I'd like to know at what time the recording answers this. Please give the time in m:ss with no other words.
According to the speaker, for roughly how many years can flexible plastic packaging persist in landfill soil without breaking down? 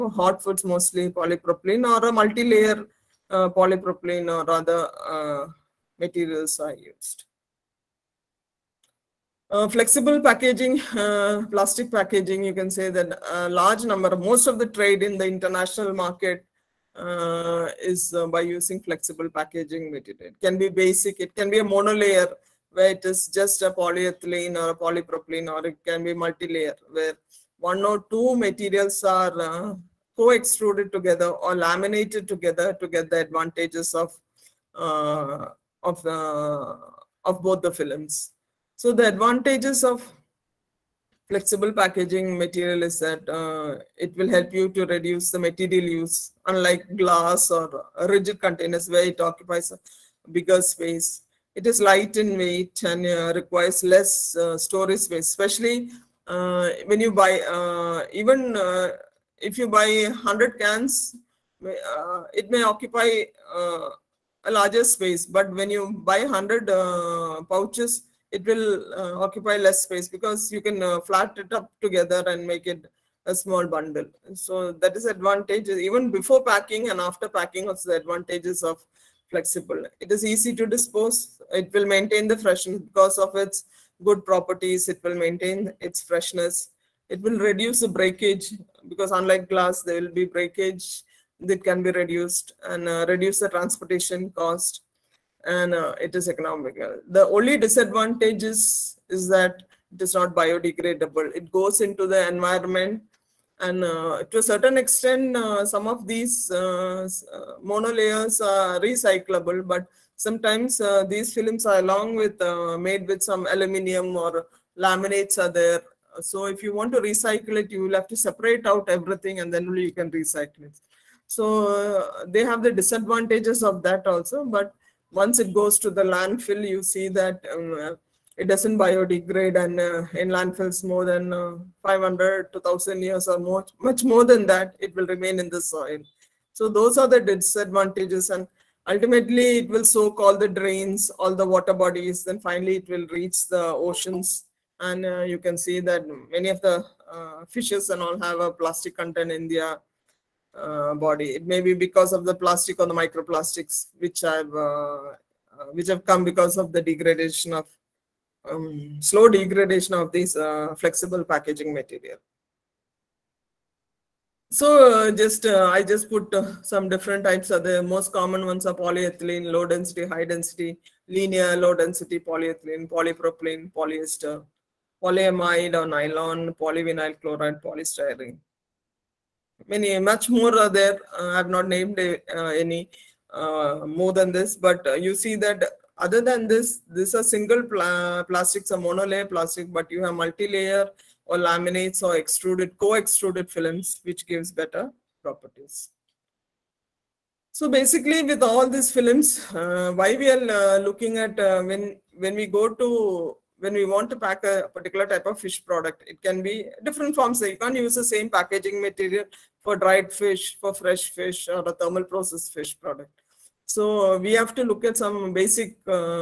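2:11.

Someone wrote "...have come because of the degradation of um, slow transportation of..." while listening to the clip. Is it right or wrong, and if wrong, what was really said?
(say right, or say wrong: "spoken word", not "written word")
wrong: "degradation", not "transportation".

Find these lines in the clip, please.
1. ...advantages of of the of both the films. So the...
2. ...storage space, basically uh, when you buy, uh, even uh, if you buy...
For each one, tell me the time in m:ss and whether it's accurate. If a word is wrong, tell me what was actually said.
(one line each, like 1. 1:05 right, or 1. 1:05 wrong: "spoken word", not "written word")
1. 0:33 right
2. 0:54 wrong: "especially", not "basically".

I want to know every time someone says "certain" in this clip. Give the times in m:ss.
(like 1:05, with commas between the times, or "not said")
1:44.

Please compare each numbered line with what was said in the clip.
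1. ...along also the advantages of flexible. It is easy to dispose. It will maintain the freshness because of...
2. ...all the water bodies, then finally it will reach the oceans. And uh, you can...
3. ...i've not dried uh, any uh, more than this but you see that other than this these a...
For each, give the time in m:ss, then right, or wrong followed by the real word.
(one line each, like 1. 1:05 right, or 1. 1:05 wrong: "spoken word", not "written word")
1. 1:17 wrong: "packing", not "along"
2. 2:21 right
3. 3:01 wrong: "named", not "dried".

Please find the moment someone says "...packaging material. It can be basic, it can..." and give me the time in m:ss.
0:19.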